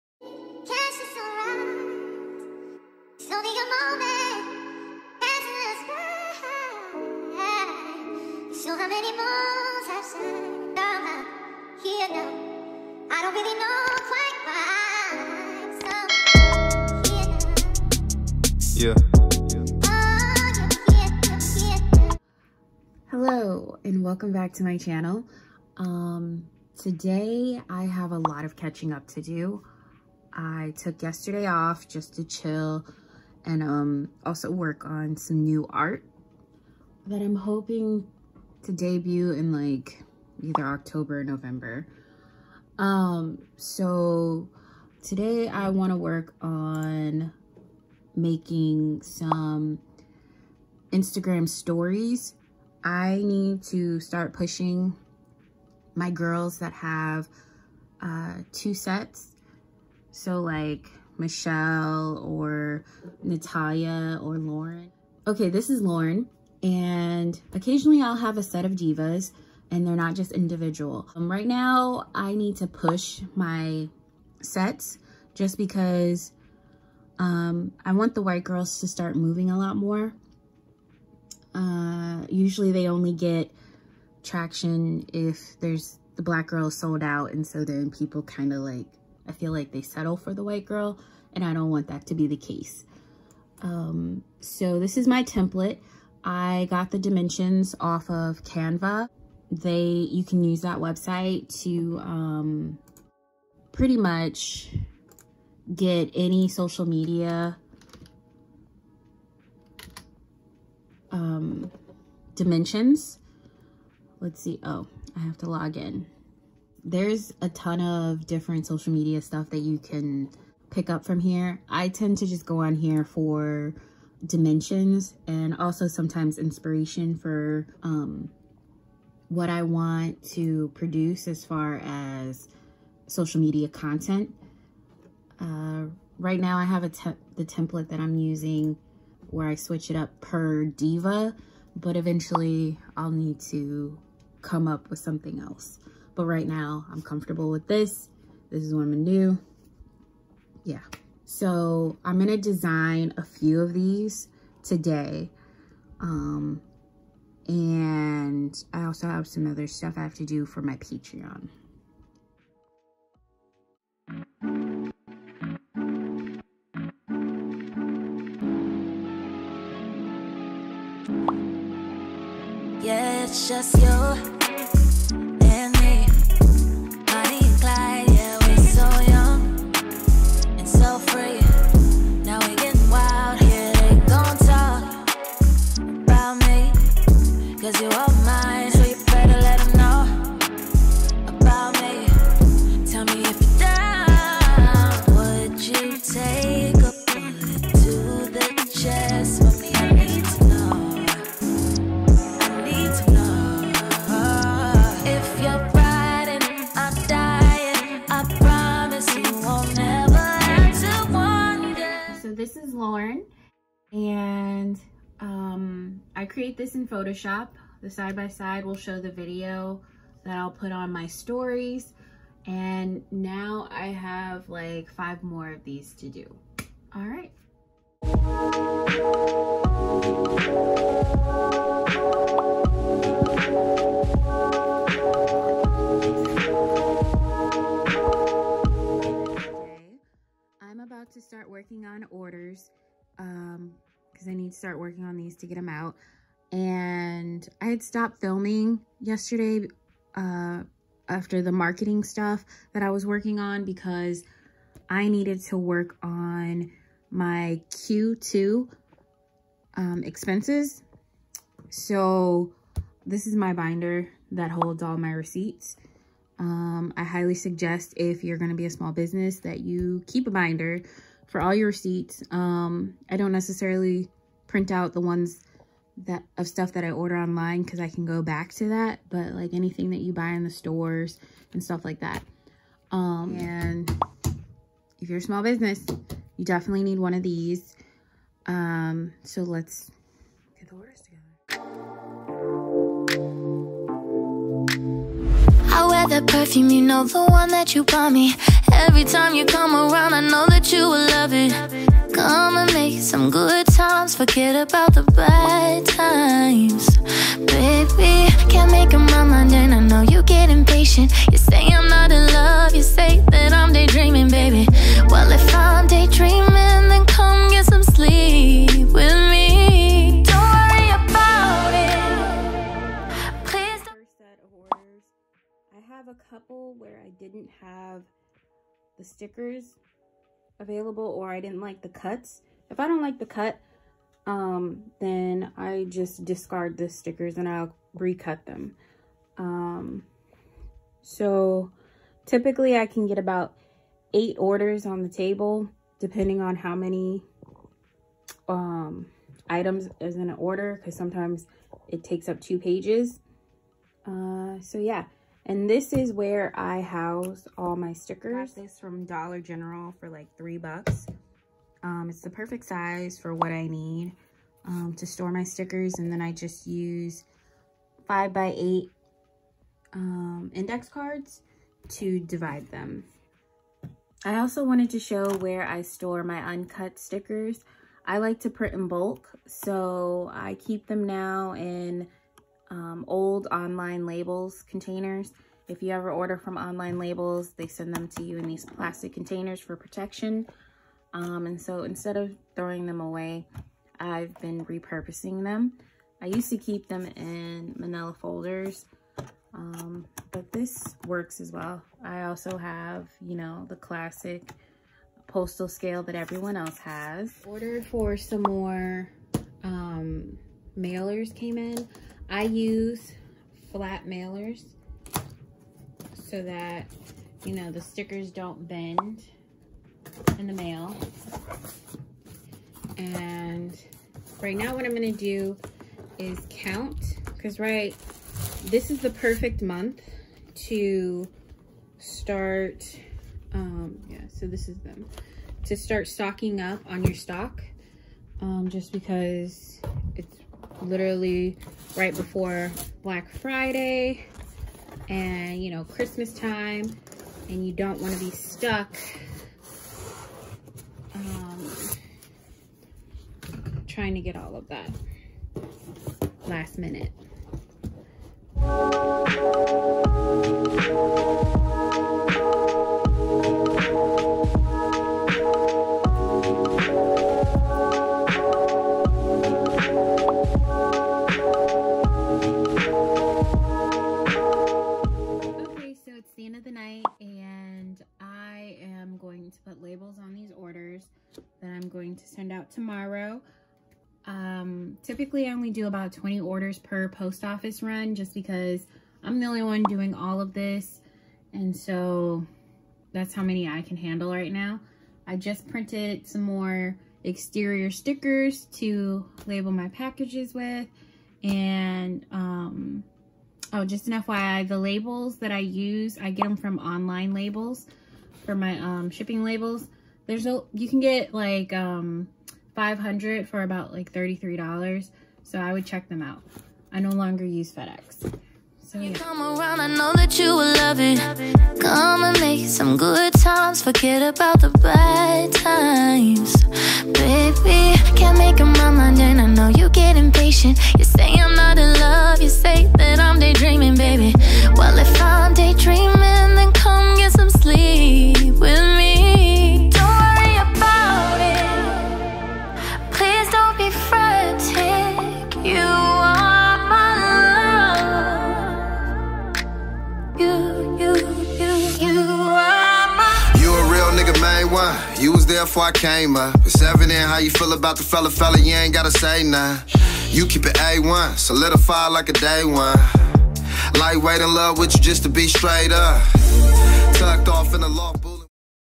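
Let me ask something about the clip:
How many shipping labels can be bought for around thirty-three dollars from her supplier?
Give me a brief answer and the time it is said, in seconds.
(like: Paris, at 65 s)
500, at 512 s.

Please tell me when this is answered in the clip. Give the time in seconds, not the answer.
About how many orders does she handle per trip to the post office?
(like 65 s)
486 s.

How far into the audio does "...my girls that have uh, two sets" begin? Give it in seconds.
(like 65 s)
55 s.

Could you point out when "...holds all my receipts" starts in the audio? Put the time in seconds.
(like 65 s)
264 s.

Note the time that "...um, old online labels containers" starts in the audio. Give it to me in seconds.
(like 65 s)
382 s.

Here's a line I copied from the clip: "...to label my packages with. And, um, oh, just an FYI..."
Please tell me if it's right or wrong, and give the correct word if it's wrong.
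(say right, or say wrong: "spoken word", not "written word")
right.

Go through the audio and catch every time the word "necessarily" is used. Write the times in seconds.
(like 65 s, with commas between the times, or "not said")
273 s.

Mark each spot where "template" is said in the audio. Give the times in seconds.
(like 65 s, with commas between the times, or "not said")
95 s, 137 s.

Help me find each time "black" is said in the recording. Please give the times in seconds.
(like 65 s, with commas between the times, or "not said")
86 s, 443 s.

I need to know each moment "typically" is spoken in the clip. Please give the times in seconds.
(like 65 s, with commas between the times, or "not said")
342 s, 485 s.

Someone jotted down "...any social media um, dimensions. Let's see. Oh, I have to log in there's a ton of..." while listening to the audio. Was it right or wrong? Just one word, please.
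right.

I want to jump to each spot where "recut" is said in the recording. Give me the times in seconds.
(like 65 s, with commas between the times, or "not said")
337 s.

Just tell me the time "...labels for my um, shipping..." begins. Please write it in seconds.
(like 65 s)
507 s.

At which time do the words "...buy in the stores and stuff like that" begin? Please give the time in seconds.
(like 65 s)
280 s.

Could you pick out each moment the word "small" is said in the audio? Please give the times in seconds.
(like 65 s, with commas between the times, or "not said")
268 s, 285 s.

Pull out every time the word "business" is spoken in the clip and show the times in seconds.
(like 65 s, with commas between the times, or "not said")
268 s, 285 s.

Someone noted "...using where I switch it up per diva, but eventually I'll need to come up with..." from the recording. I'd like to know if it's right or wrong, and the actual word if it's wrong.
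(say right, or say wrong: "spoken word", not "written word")
right.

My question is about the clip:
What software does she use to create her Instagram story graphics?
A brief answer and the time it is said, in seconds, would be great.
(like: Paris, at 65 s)
Photoshop, at 216 s.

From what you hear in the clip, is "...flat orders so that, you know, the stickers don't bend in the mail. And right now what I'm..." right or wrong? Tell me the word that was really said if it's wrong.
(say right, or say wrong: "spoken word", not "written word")
wrong: "mailers", not "orders".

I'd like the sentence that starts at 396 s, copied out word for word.
I used to keep them in manila folders, um, but this works as well.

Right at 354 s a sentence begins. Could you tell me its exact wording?
Uh, so yeah, and this is where I house all my stickers.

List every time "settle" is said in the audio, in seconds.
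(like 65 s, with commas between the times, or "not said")
89 s.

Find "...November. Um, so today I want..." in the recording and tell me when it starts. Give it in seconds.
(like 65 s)
41 s.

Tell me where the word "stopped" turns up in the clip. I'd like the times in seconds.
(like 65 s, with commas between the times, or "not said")
247 s.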